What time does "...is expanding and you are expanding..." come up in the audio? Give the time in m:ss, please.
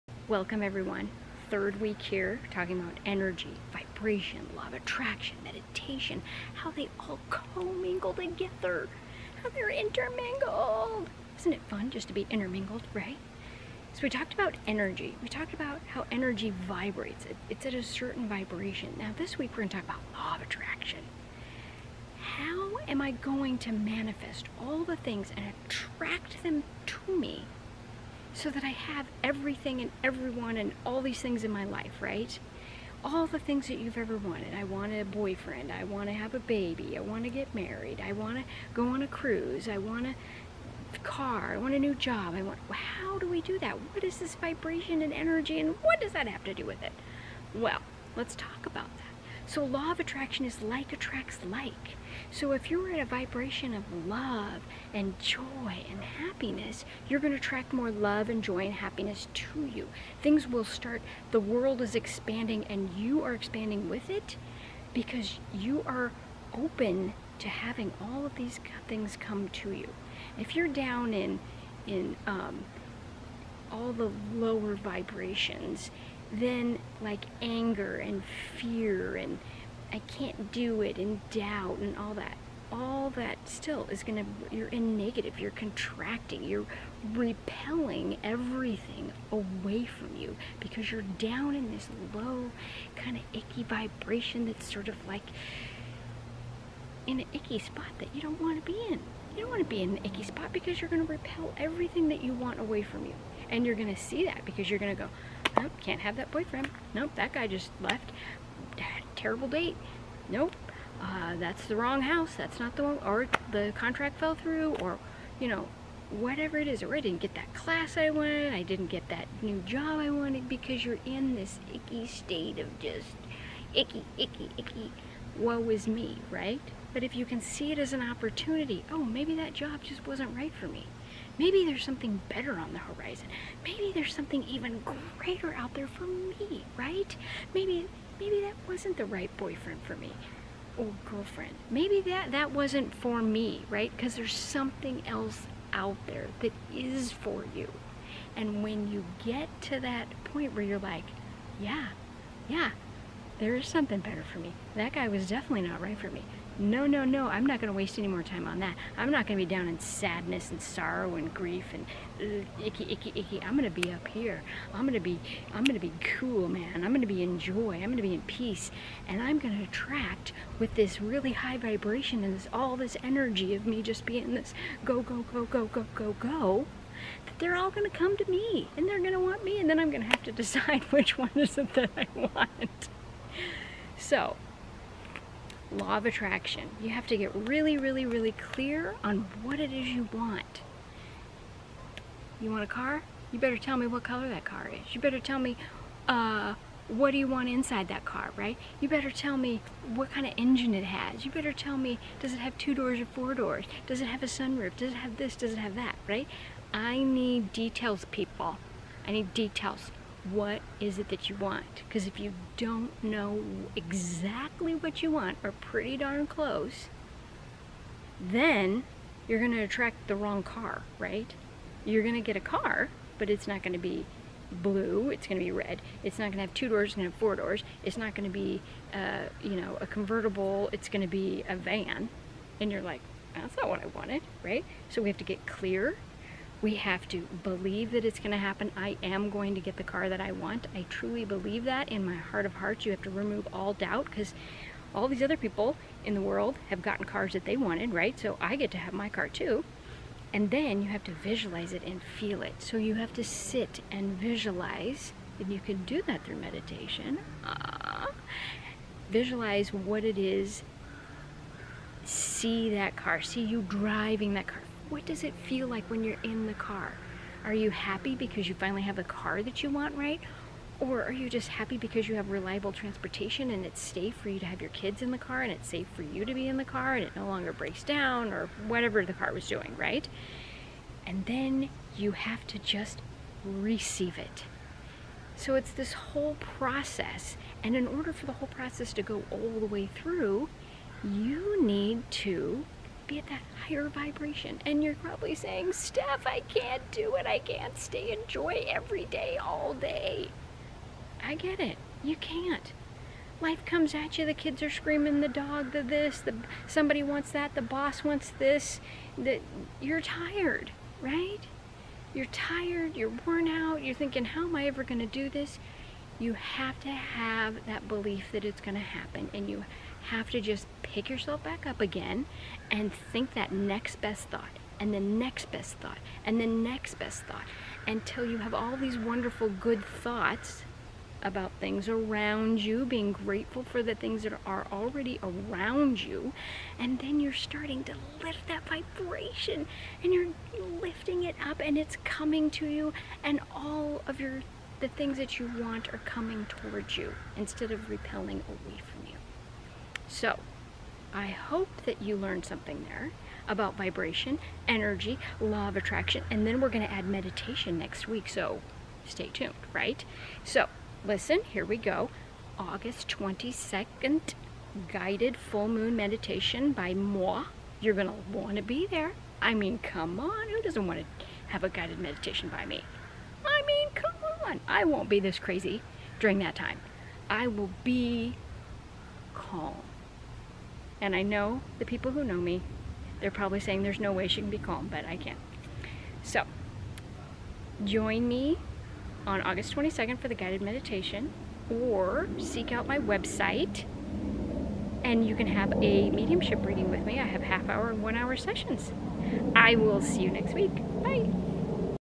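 1:01.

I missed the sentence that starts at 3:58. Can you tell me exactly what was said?
I am going to get the car that I want.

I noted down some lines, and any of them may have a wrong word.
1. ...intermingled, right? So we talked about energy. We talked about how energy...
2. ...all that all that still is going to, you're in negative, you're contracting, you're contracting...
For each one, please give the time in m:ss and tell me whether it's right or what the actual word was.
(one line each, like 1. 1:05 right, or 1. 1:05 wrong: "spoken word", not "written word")
1. 0:12 right
2. 1:21 wrong: "repelling", not "contracting".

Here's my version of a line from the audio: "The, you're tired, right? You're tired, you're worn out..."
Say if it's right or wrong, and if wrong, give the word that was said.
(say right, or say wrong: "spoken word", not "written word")
right.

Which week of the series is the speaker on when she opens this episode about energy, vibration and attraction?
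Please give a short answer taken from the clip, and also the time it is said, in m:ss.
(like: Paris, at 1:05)
Third, at 0:01.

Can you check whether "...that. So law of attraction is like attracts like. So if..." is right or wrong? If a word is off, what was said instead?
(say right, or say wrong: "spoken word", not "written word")
right.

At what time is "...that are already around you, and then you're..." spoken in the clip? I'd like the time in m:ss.
5:34.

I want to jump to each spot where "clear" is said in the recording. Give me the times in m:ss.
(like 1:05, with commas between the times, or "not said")
3:08, 3:55.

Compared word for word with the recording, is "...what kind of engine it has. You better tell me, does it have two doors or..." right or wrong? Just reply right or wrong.
right.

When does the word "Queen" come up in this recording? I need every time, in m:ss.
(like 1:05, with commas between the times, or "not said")
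not said.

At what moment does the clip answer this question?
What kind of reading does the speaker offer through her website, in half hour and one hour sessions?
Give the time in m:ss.
6:36.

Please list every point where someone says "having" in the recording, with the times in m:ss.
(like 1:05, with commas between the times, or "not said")
1:07.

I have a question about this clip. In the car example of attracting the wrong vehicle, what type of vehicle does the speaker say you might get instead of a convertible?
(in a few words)
A van.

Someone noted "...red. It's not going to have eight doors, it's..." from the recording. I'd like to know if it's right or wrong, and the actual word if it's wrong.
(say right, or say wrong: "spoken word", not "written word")
wrong: "two", not "eight".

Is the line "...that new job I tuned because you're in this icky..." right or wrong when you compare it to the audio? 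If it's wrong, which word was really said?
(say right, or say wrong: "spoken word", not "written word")
wrong: "wanted", not "tuned".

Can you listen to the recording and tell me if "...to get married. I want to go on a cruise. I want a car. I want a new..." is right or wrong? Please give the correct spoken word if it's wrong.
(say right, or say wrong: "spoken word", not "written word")
right.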